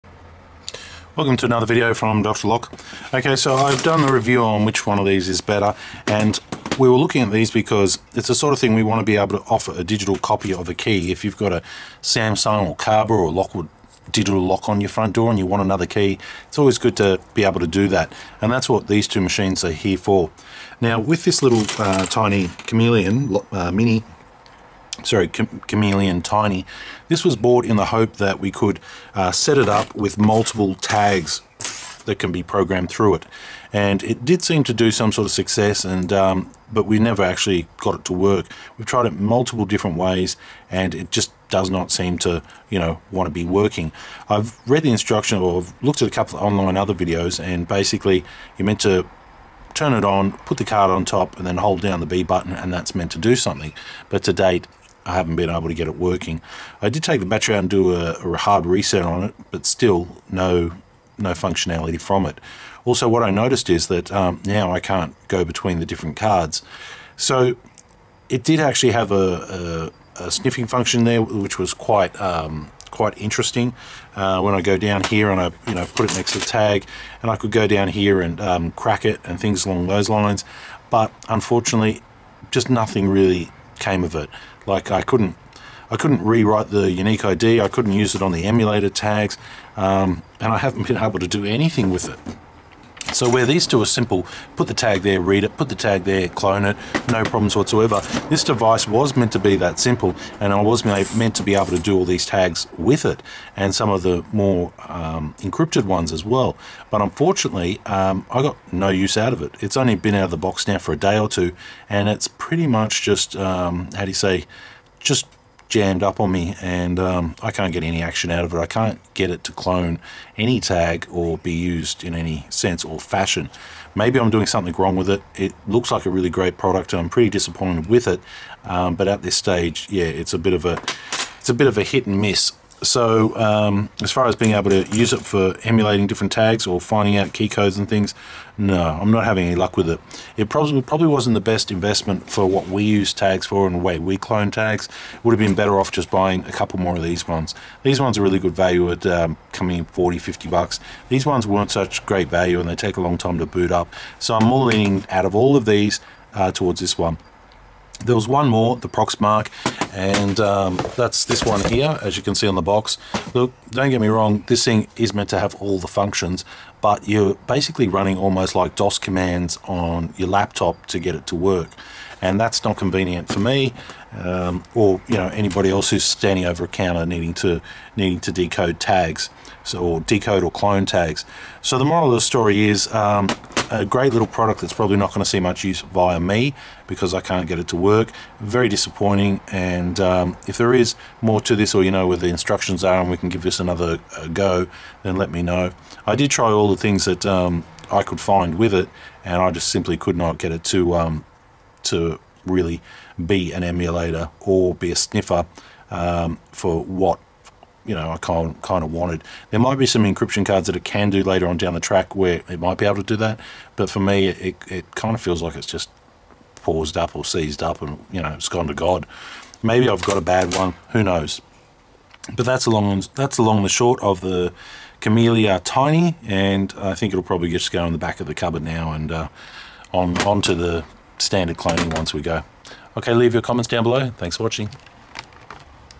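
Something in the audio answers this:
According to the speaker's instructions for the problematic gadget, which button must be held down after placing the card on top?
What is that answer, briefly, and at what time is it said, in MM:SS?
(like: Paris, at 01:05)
B button, at 00:52.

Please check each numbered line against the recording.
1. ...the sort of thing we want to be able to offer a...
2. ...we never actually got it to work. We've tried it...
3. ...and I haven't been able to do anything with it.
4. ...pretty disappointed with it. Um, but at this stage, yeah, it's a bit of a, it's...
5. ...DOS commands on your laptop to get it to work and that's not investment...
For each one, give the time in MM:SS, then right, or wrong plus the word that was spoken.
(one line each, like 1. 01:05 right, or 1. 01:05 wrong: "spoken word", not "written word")
1. 00:08 right
2. 00:36 right
3. 01:30 right
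4. 02:07 right
5. 02:48 wrong: "convenient", not "investment".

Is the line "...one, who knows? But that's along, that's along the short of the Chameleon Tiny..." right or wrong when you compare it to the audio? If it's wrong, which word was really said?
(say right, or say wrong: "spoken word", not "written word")
right.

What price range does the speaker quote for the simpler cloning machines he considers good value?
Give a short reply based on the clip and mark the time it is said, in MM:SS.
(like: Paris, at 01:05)
40 to 50 dollars, at 02:29.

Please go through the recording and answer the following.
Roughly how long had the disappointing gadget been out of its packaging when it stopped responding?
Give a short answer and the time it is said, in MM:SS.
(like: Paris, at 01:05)
A day or two, at 01:50.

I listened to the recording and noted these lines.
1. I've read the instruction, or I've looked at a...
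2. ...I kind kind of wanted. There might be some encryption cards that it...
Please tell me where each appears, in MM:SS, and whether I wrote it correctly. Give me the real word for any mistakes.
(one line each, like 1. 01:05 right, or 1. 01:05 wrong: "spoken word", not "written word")
1. 00:44 right
2. 03:28 right.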